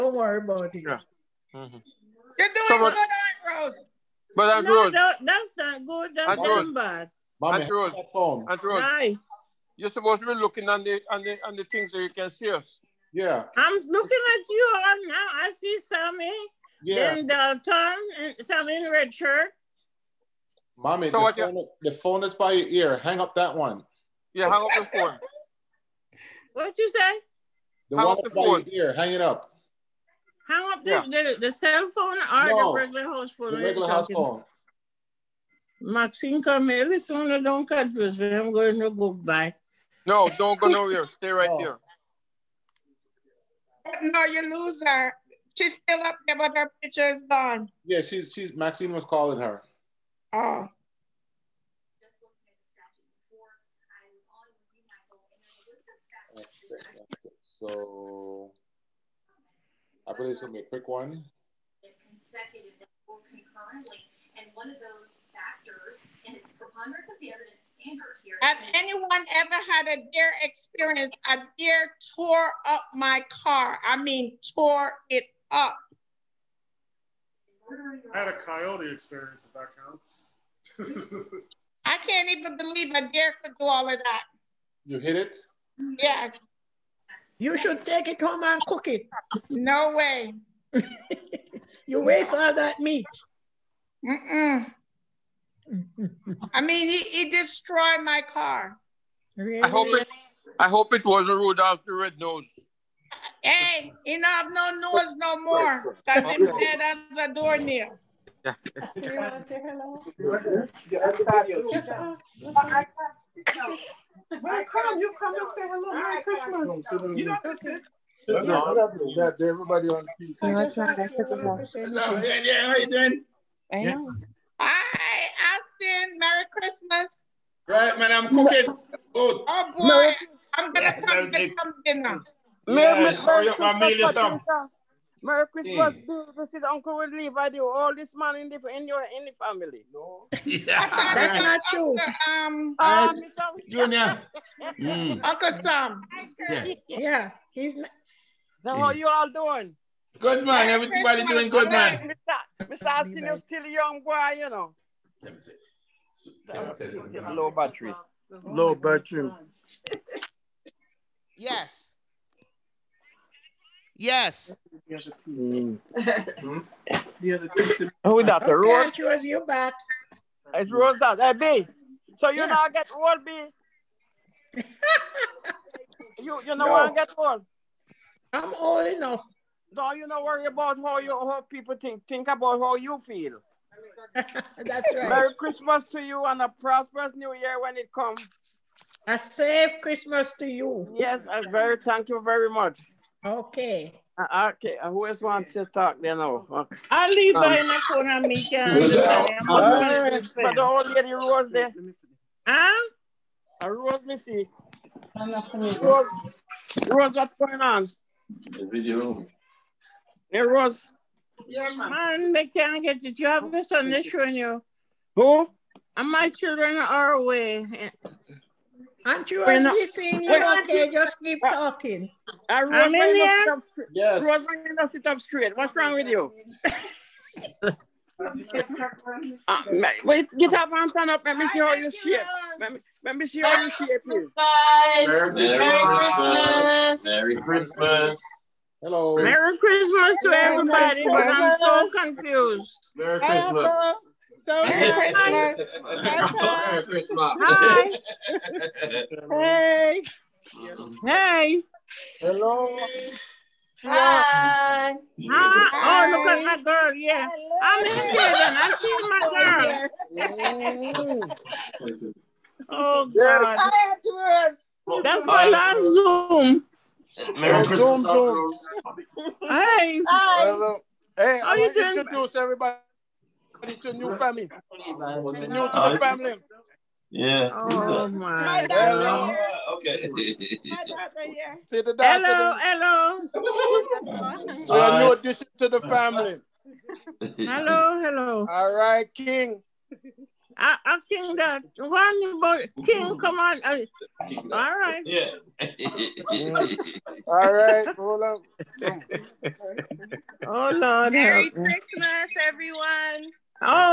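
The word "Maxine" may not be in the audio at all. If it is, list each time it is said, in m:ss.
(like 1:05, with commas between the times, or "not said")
0:35, 0:48.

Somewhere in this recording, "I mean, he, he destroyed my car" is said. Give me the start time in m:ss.
1:36.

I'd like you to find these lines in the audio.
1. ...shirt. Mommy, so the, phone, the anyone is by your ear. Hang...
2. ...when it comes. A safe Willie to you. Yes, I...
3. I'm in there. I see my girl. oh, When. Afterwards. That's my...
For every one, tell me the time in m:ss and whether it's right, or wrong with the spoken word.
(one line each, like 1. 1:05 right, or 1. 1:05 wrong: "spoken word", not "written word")
1. 0:19 wrong: "phone", not "anyone"
2. 3:07 wrong: "Christmas", not "Willie"
3. 4:17 wrong: "God", not "When".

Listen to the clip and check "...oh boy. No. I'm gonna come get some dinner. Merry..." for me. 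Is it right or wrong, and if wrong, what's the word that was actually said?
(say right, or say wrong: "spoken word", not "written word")
right.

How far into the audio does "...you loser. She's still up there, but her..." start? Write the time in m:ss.
0:44.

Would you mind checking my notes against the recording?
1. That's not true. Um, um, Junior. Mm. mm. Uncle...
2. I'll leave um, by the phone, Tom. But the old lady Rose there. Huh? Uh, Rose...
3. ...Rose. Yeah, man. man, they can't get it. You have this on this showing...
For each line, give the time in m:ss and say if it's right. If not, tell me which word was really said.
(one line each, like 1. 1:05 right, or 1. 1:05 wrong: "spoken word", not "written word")
1. 2:21 right
2. 3:16 wrong: "Mika", not "Tom"
3. 3:30 right.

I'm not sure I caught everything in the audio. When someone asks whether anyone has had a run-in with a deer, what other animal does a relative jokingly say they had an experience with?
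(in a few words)
coyote.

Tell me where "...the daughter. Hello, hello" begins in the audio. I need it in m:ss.
4:41.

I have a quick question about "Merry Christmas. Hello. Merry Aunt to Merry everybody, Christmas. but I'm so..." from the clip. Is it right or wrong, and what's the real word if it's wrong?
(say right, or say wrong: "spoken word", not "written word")
wrong: "Christmas", not "Aunt".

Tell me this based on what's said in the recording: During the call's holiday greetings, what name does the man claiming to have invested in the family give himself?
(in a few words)
Uncle Willie.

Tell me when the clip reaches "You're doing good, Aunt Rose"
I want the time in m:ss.
0:02.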